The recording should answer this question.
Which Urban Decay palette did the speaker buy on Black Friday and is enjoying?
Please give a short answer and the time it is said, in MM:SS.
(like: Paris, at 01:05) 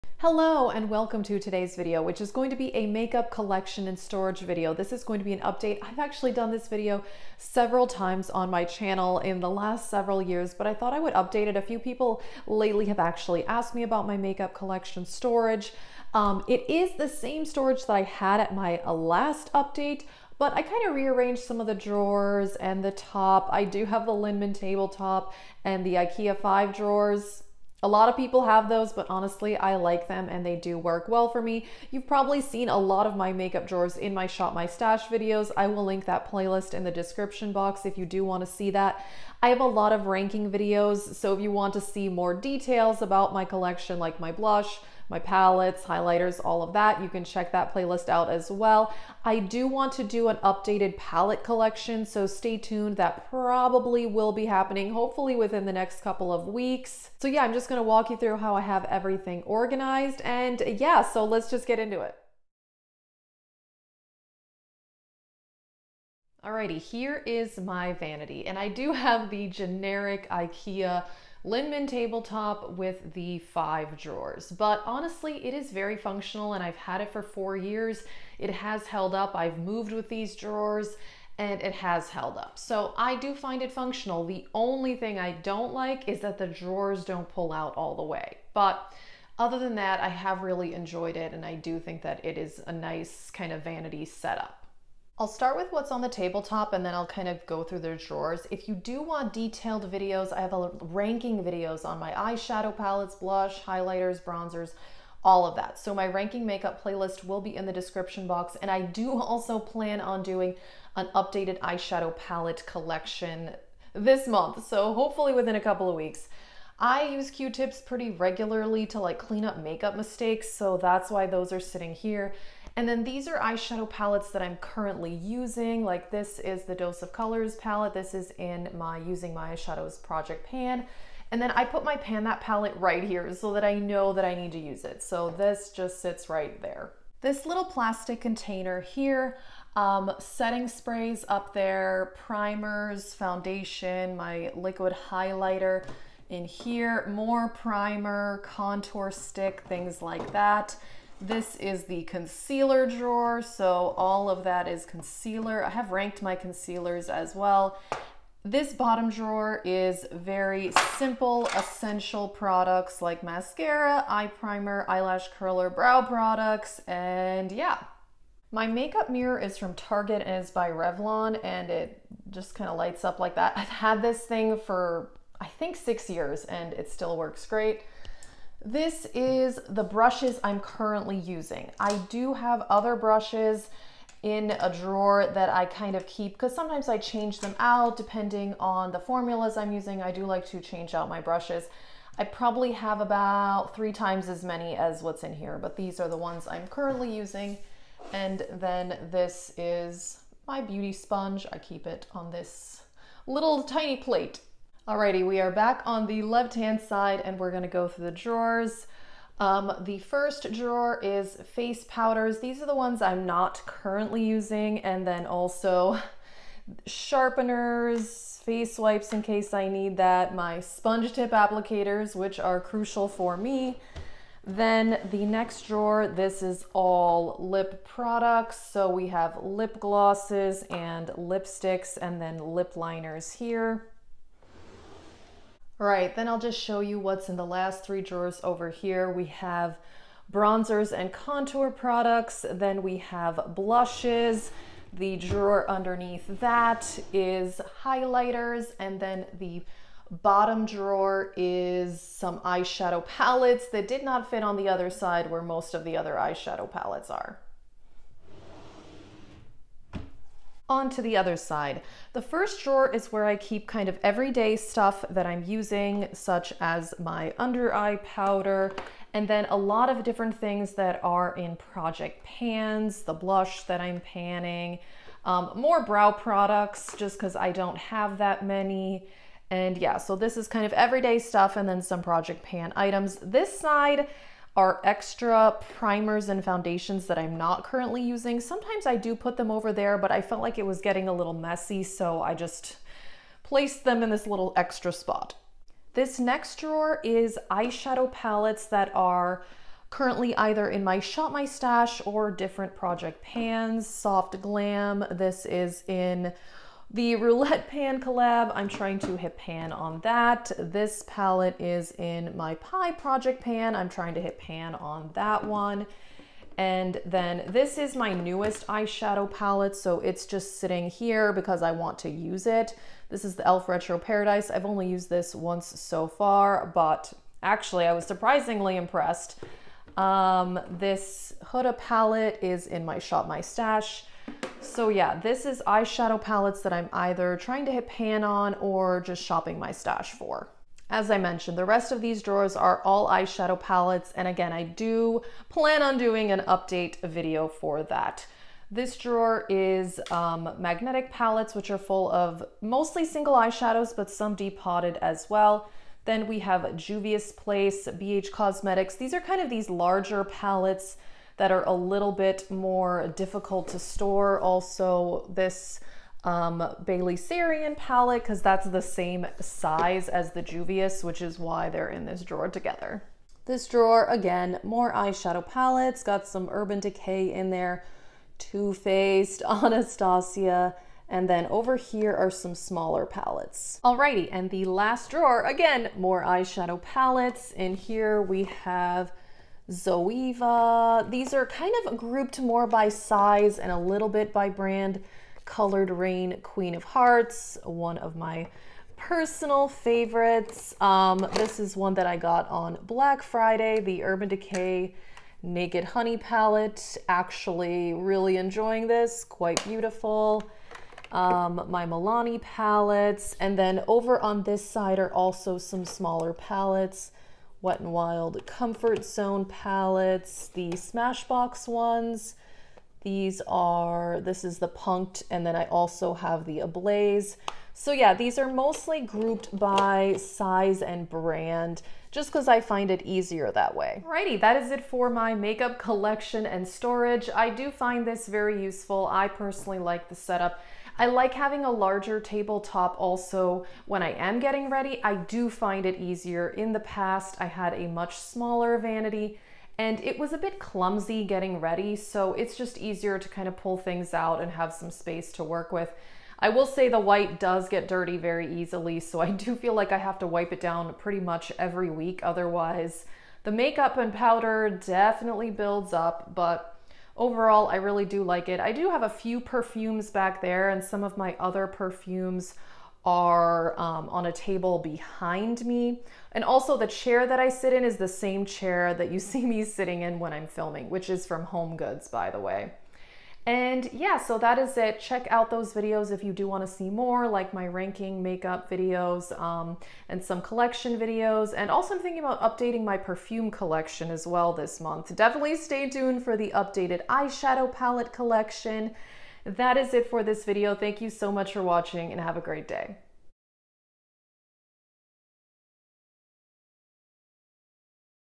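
Naked Honey, at 06:45.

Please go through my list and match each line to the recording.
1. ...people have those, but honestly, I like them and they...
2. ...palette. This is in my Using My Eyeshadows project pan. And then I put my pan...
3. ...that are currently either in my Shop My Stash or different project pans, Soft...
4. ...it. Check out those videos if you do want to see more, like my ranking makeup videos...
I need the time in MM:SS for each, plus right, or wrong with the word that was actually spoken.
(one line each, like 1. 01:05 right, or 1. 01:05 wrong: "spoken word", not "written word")
1. 00:28 right
2. 02:07 right
3. 04:58 right
4. 08:04 right.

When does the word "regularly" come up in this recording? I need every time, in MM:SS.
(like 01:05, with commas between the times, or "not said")
01:58.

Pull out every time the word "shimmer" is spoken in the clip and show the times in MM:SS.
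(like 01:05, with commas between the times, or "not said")
not said.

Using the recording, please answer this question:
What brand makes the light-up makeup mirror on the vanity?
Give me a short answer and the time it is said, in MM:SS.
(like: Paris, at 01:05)
Revlon, at 02:50.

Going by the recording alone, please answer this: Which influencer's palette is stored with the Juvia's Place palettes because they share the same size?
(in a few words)
Bailey Sarian.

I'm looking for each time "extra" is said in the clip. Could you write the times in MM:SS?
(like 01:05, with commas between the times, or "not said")
04:44, 04:54.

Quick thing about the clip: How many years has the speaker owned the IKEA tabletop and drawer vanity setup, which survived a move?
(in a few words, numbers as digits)
4.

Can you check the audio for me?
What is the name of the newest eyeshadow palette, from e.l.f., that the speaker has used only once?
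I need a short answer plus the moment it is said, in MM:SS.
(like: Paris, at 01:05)
Retro Paradise, at 05:23.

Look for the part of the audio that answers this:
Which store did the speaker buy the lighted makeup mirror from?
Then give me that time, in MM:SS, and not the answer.
02:49.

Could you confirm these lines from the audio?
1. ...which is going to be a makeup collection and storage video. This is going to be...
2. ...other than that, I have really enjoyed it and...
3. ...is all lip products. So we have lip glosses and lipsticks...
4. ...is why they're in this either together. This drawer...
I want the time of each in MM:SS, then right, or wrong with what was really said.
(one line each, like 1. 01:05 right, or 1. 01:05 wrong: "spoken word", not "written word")
1. 00:02 right
2. 01:29 right
3. 03:46 right
4. 06:11 wrong: "drawer", not "either".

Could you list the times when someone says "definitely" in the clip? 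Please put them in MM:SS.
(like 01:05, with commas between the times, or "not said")
07:44, 08:15.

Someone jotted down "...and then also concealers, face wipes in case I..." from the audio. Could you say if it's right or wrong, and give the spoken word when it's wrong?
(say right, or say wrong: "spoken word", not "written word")
wrong: "sharpeners", not "concealers".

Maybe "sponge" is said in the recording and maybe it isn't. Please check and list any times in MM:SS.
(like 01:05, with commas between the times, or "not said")
03:20, 03:40.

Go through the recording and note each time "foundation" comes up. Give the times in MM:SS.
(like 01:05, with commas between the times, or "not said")
02:23, 04:46.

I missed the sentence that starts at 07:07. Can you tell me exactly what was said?
So yeah, these are mostly grouped by size and brand, just because I find it easier that way.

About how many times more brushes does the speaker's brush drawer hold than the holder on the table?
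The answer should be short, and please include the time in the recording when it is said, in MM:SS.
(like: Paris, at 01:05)
3, at 03:13.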